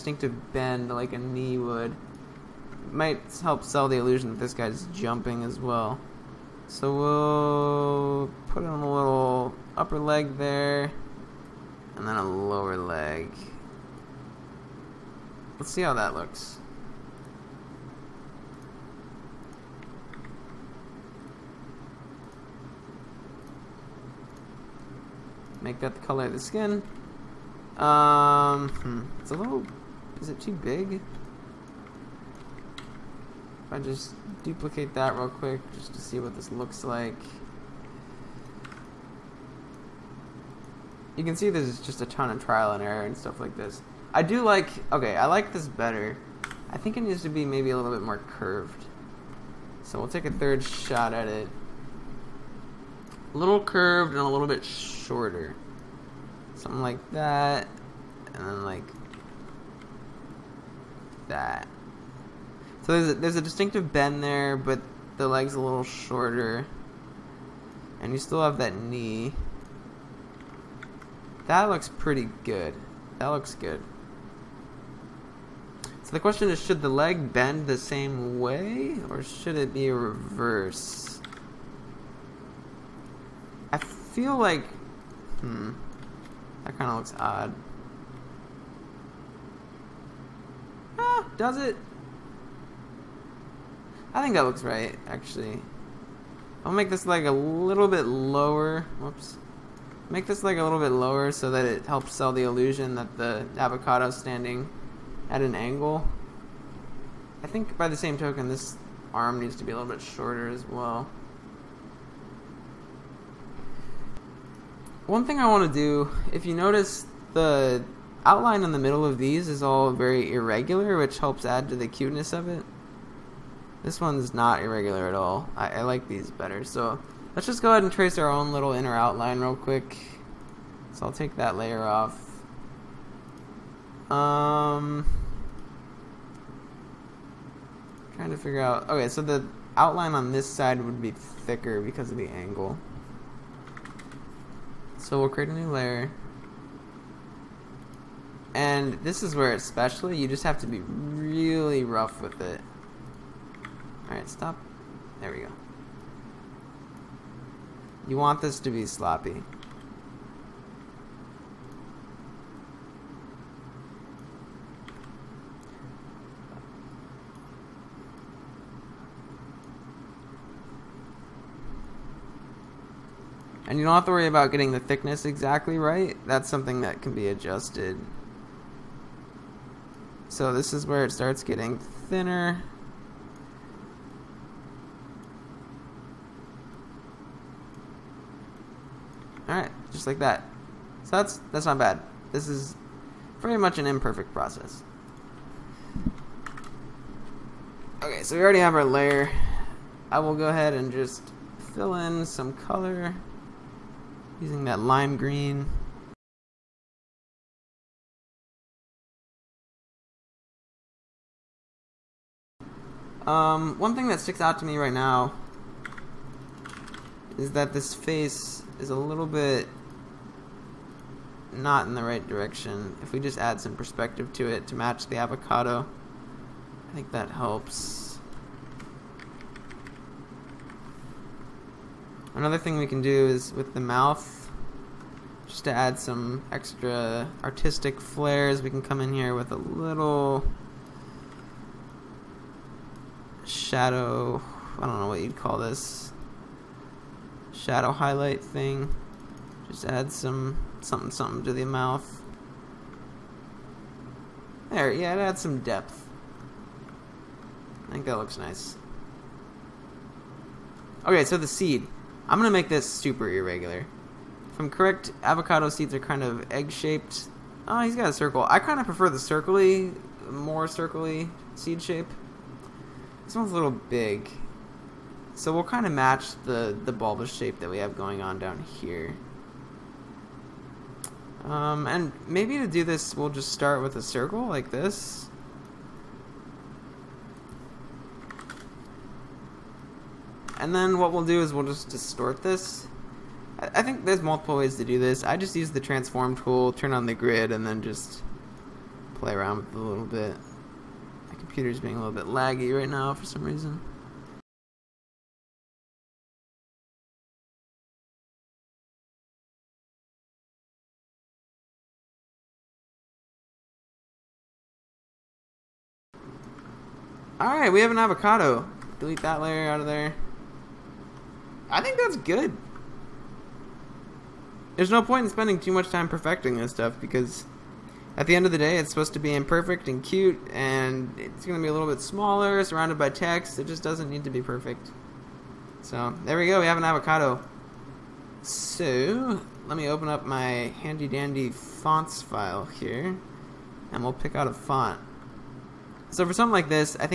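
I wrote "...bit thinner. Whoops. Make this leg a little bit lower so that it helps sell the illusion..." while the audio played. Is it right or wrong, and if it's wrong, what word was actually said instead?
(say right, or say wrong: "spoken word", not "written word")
wrong: "lower", not "thinner".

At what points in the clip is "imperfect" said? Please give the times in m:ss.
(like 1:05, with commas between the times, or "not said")
3:13, 5:29.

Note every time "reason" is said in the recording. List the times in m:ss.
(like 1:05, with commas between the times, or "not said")
5:03.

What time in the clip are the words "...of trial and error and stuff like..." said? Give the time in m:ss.
0:42.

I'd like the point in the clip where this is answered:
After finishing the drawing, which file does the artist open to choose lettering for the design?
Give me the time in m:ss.
5:41.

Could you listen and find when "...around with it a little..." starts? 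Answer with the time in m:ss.
4:59.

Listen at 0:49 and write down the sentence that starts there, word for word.
So we'll take a third shot at it.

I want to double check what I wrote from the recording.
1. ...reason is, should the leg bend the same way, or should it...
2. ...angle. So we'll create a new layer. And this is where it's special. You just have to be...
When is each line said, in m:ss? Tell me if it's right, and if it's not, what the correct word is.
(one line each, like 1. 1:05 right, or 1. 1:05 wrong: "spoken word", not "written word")
1. 1:16 wrong: "question", not "reason"
2. 2:22 right.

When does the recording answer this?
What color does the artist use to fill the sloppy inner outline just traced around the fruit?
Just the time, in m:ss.
3:24.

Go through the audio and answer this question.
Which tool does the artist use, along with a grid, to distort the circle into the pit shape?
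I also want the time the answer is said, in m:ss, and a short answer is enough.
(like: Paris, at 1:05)
transform tool, at 4:55.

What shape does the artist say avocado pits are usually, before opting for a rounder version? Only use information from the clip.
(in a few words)
egg-shaped.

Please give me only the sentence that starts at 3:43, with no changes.
If we just add some perspective to it to match the avocado, I think that helps.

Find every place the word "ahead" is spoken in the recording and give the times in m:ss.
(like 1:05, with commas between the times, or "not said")
2:07, 3:20.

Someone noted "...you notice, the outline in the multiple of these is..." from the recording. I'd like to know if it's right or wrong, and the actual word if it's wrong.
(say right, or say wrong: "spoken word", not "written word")
wrong: "middle", not "multiple".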